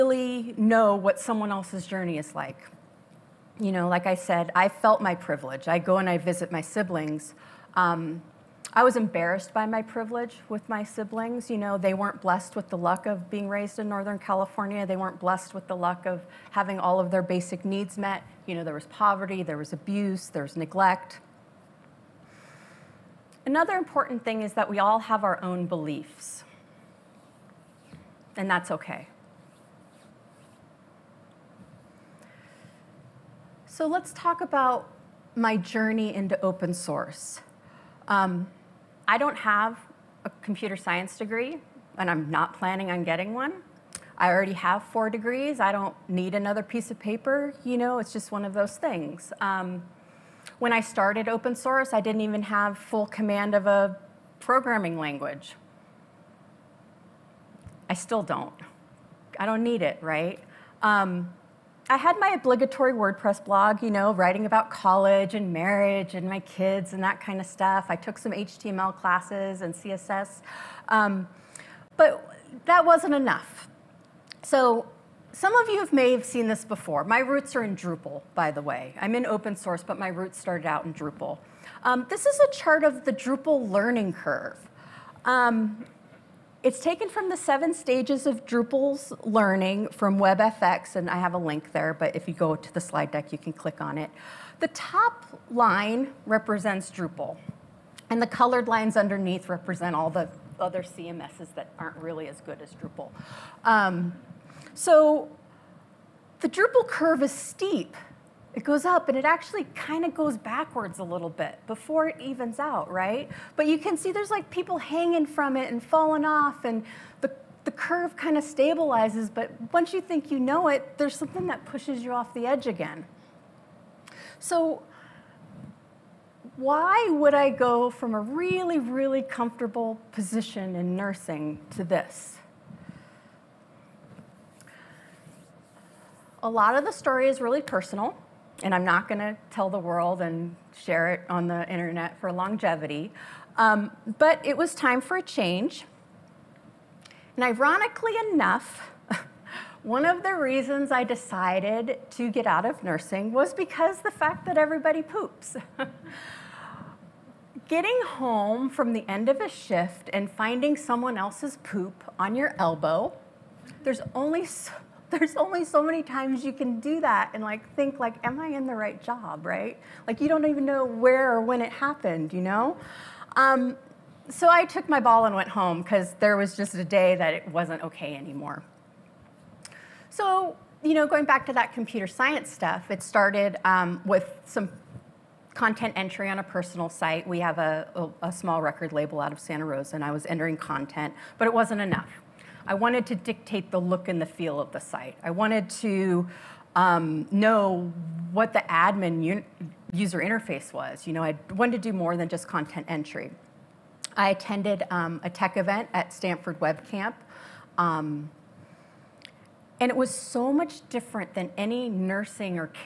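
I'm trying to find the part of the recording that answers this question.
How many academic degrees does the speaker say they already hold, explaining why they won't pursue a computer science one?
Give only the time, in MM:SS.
00:44.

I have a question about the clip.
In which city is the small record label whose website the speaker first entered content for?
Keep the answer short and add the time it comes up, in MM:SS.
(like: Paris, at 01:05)
Santa Rosa, at 03:09.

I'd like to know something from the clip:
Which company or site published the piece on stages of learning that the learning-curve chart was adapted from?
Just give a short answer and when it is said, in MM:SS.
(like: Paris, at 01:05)
WebFX, at 01:30.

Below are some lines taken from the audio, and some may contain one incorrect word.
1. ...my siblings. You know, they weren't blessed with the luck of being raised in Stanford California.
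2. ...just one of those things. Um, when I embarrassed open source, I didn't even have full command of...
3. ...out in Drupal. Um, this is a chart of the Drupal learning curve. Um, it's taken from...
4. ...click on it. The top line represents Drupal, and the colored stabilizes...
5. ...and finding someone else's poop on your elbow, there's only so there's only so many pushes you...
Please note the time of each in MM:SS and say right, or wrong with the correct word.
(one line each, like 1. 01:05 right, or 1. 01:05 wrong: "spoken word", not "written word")
1. 00:10 wrong: "Northern", not "Stanford"
2. 00:48 wrong: "started", not "embarrassed"
3. 01:20 right
4. 01:33 wrong: "lines", not "stabilizes"
5. 02:40 wrong: "times", not "pushes".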